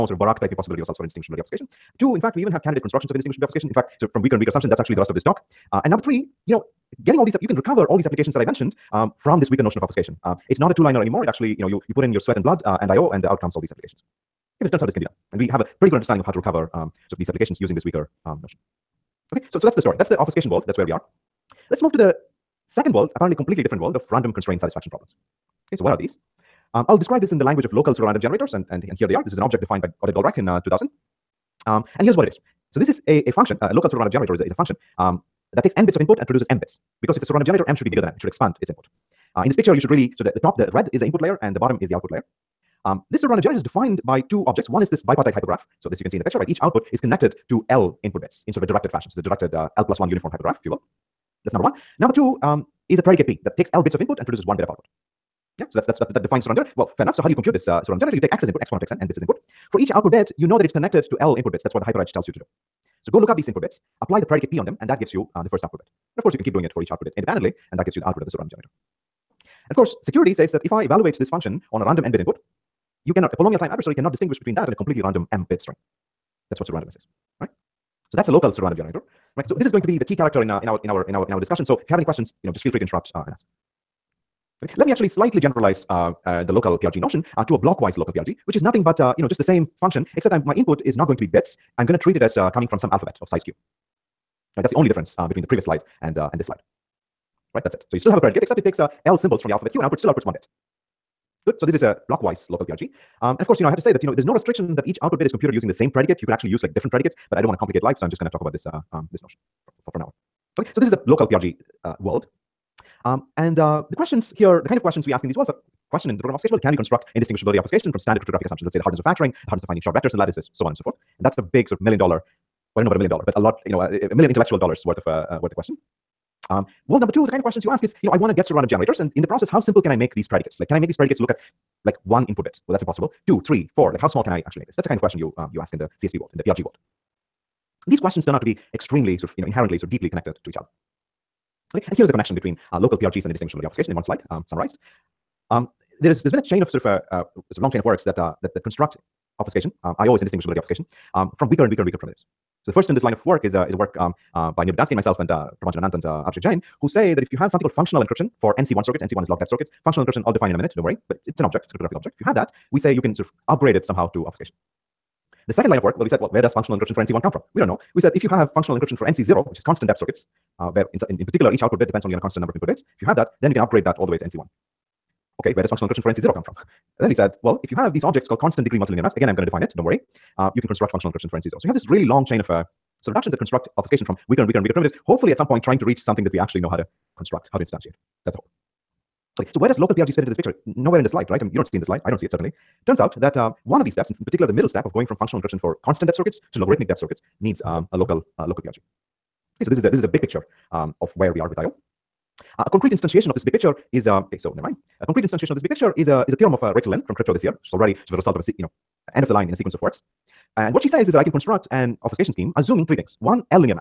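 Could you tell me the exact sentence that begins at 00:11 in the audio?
It actually, you know, you, you put in your sweat and blood uh, and IO and uh, out comes all these applications.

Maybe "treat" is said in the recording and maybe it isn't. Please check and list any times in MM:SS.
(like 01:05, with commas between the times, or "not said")
01:32.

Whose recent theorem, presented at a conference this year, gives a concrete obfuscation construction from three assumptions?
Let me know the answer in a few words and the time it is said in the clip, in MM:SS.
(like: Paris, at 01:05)
Rachel Lin, at 03:26.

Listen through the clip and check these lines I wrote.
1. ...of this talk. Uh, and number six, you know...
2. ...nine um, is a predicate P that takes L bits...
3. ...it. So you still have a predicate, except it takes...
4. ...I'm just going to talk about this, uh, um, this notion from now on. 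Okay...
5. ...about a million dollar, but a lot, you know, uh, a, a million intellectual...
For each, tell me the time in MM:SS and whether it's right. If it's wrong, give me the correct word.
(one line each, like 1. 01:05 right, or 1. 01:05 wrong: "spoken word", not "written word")
1. 00:05 wrong: "three", not "six"
2. 00:52 wrong: "two", not "nine"
3. 01:37 right
4. 01:48 right
5. 02:02 right.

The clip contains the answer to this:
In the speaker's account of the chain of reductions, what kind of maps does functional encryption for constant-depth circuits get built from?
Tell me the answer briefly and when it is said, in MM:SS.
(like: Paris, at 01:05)
constant degree multilinear maps, at 02:58.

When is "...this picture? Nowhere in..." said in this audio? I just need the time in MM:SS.
03:10.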